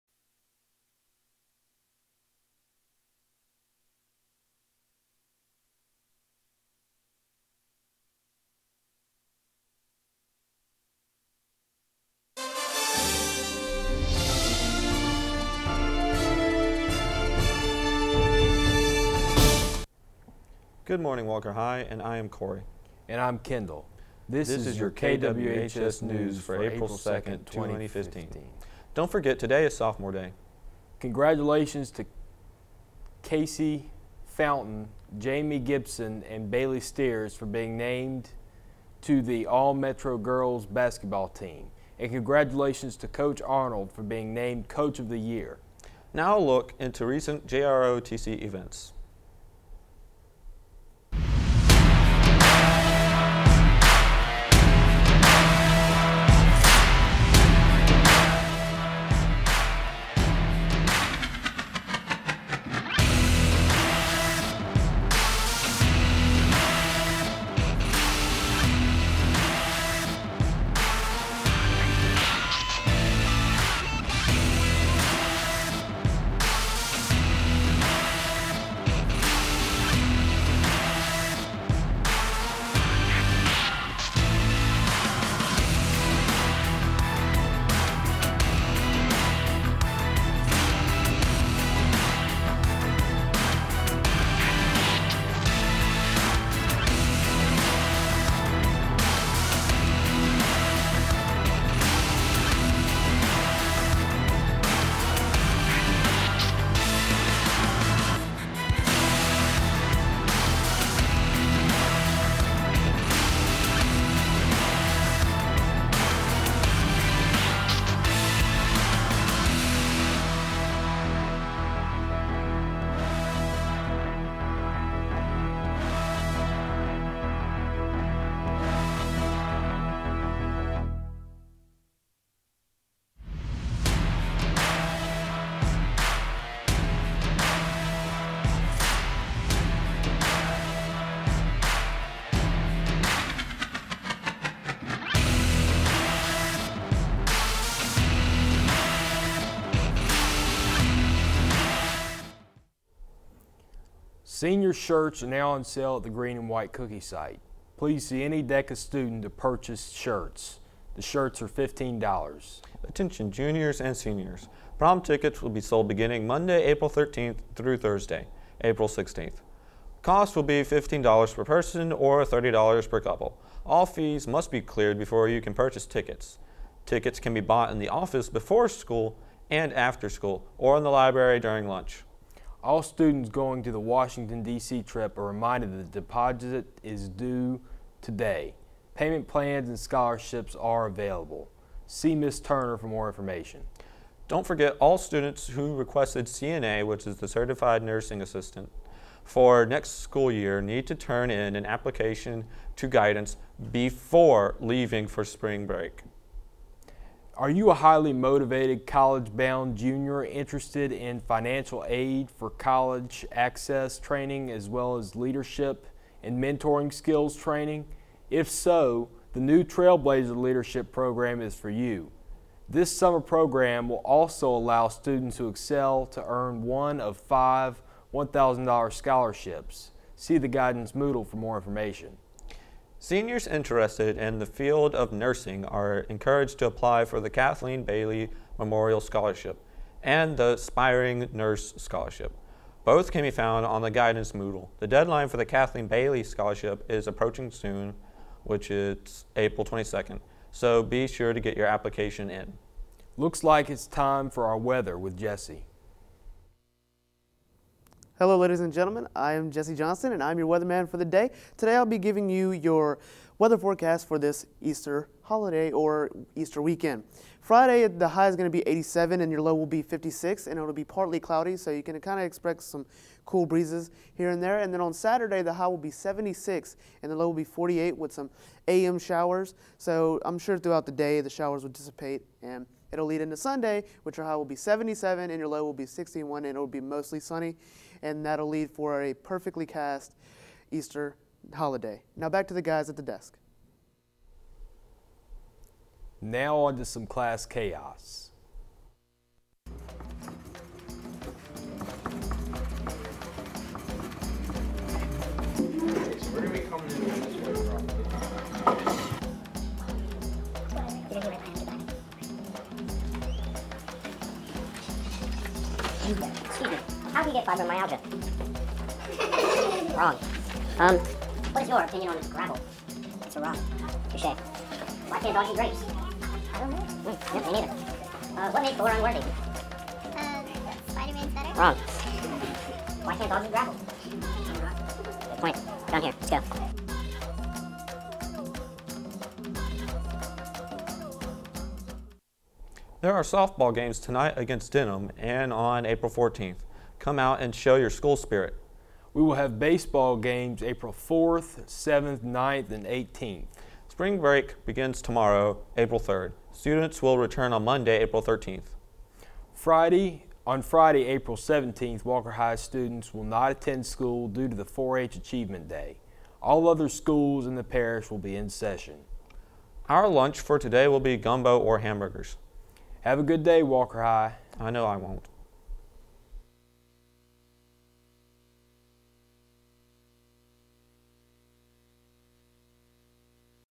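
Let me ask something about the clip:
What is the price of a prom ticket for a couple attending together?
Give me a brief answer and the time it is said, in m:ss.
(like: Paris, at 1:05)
$30, at 2:52.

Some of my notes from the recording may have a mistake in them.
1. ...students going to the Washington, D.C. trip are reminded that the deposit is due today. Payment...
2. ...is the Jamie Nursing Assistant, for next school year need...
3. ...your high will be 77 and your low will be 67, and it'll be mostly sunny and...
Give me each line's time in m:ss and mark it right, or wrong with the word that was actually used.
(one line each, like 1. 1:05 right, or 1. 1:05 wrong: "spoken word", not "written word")
1. 3:02 right
2. 3:17 wrong: "Certified", not "Jamie"
3. 4:44 wrong: "61", not "67".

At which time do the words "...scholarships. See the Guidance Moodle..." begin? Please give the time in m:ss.
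3:48.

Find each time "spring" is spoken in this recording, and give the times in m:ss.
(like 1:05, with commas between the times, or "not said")
3:25, 5:53.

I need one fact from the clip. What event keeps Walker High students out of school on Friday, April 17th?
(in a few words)
4-H Achievement Day.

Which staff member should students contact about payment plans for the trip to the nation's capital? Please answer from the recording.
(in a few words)
Ms. Turner.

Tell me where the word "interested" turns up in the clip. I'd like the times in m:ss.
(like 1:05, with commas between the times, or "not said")
3:30, 3:53.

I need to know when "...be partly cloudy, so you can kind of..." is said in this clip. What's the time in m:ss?
4:30.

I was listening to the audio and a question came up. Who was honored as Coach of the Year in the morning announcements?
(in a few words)
Coach Arnold.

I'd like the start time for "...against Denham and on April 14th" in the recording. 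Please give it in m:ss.
5:44.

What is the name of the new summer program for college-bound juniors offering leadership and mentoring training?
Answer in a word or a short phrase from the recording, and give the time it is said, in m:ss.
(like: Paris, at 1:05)
Trailblazer Leadership Program, at 3:39.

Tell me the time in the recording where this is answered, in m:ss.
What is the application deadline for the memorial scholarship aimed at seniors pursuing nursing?
4:09.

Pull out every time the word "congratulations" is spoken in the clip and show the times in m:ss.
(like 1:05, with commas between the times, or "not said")
0:30, 0:42.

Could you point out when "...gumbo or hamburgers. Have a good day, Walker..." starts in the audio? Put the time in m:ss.
6:11.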